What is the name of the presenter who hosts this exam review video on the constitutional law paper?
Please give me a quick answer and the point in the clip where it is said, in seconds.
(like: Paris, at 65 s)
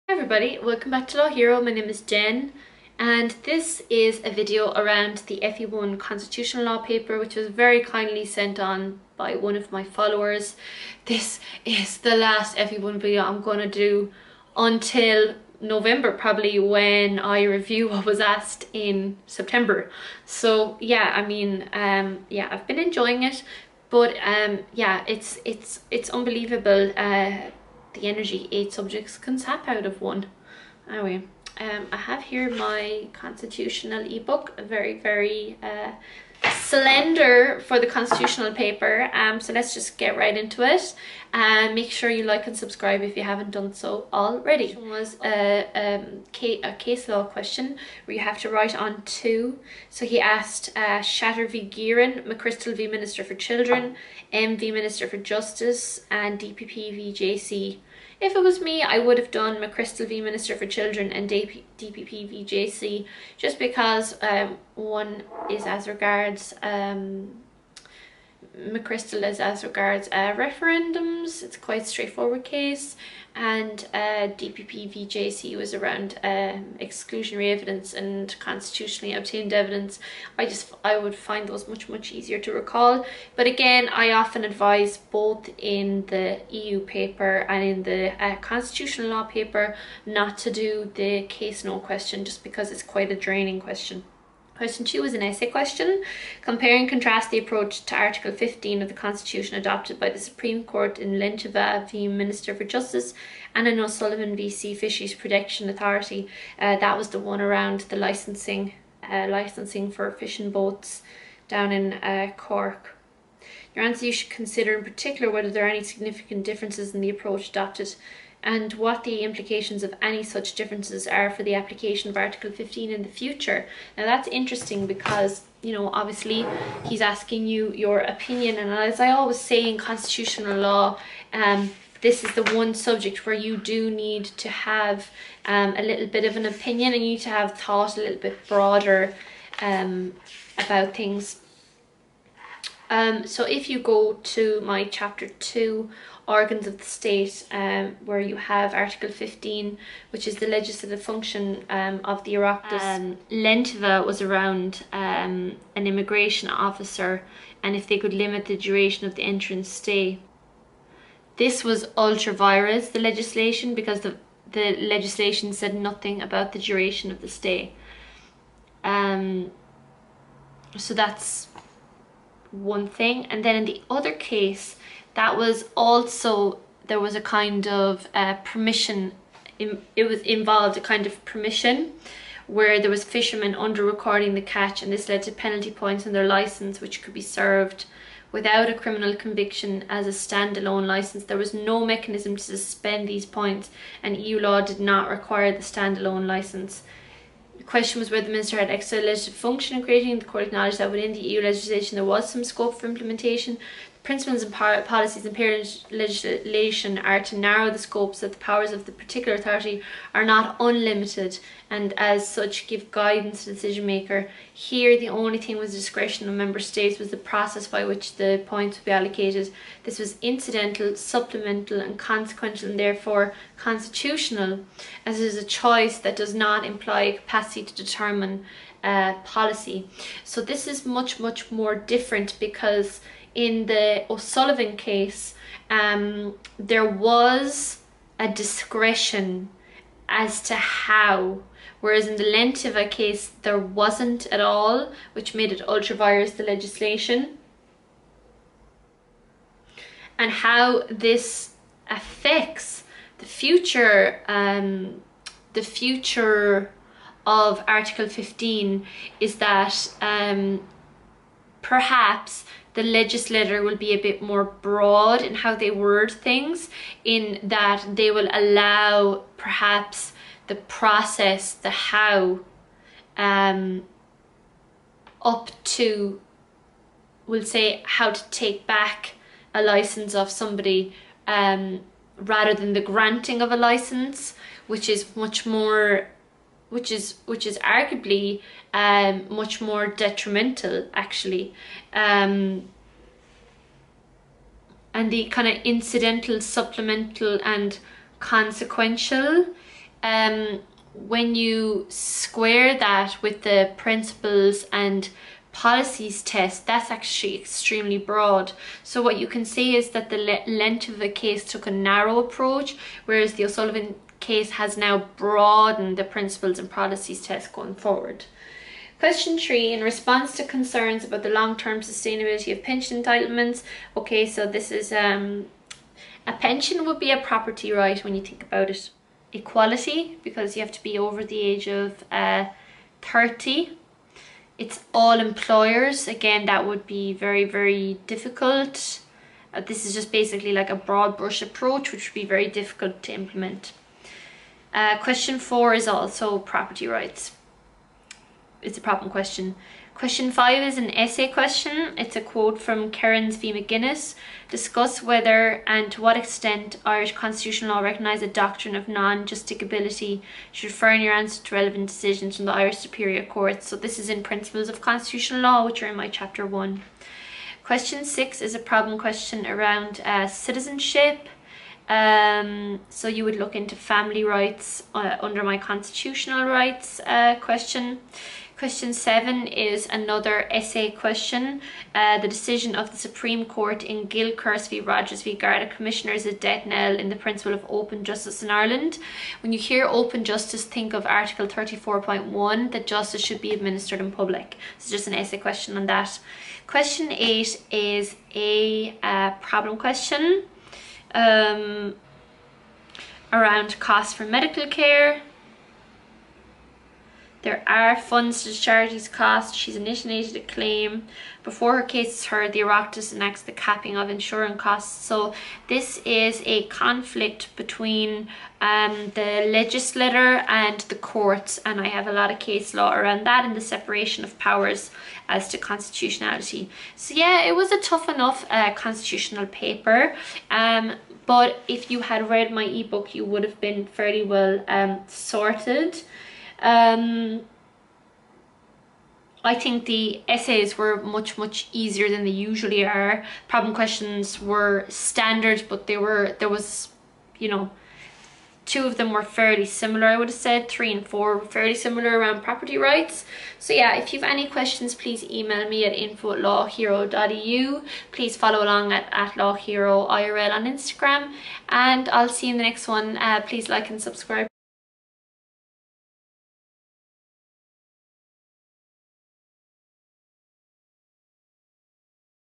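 Jen, at 1 s.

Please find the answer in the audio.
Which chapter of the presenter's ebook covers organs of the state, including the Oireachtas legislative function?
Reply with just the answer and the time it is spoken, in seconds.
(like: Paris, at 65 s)
Chapter 2, at 144 s.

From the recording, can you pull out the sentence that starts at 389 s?
When you hear open justice, think of Article 34.1 that justice should be administered in public.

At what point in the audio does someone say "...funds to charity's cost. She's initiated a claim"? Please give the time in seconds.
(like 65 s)
407 s.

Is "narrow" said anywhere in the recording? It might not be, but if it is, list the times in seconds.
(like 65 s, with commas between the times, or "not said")
207 s, 311 s.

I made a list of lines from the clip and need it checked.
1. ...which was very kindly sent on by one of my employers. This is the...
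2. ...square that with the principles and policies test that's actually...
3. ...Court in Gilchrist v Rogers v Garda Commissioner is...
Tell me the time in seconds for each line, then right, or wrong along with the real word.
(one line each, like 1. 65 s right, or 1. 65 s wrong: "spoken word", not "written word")
1. 7 s wrong: "followers", not "employers"
2. 301 s right
3. 383 s right.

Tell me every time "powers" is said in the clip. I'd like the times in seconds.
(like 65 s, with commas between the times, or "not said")
208 s, 424 s.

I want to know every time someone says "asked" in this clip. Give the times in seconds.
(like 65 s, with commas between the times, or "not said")
18 s, 50 s.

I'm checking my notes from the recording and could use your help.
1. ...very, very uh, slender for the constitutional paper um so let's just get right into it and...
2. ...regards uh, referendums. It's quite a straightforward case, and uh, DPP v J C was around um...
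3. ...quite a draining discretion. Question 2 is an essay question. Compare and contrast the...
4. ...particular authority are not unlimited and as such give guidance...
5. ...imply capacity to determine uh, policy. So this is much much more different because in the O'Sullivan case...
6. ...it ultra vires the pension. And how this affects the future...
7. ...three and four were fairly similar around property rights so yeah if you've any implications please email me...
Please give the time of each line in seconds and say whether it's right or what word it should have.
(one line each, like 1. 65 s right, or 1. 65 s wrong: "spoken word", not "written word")
1. 34 s right
2. 69 s right
3. 92 s wrong: "question", not "discretion"
4. 208 s right
5. 226 s right
6. 245 s wrong: "legislation", not "pension"
7. 450 s wrong: "questions", not "implications".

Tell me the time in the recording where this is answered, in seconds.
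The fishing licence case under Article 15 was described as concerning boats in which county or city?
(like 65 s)
112 s.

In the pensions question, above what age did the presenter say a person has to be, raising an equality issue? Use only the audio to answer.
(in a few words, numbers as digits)
30.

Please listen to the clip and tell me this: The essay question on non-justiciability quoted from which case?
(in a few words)
Kerins v McGuinness.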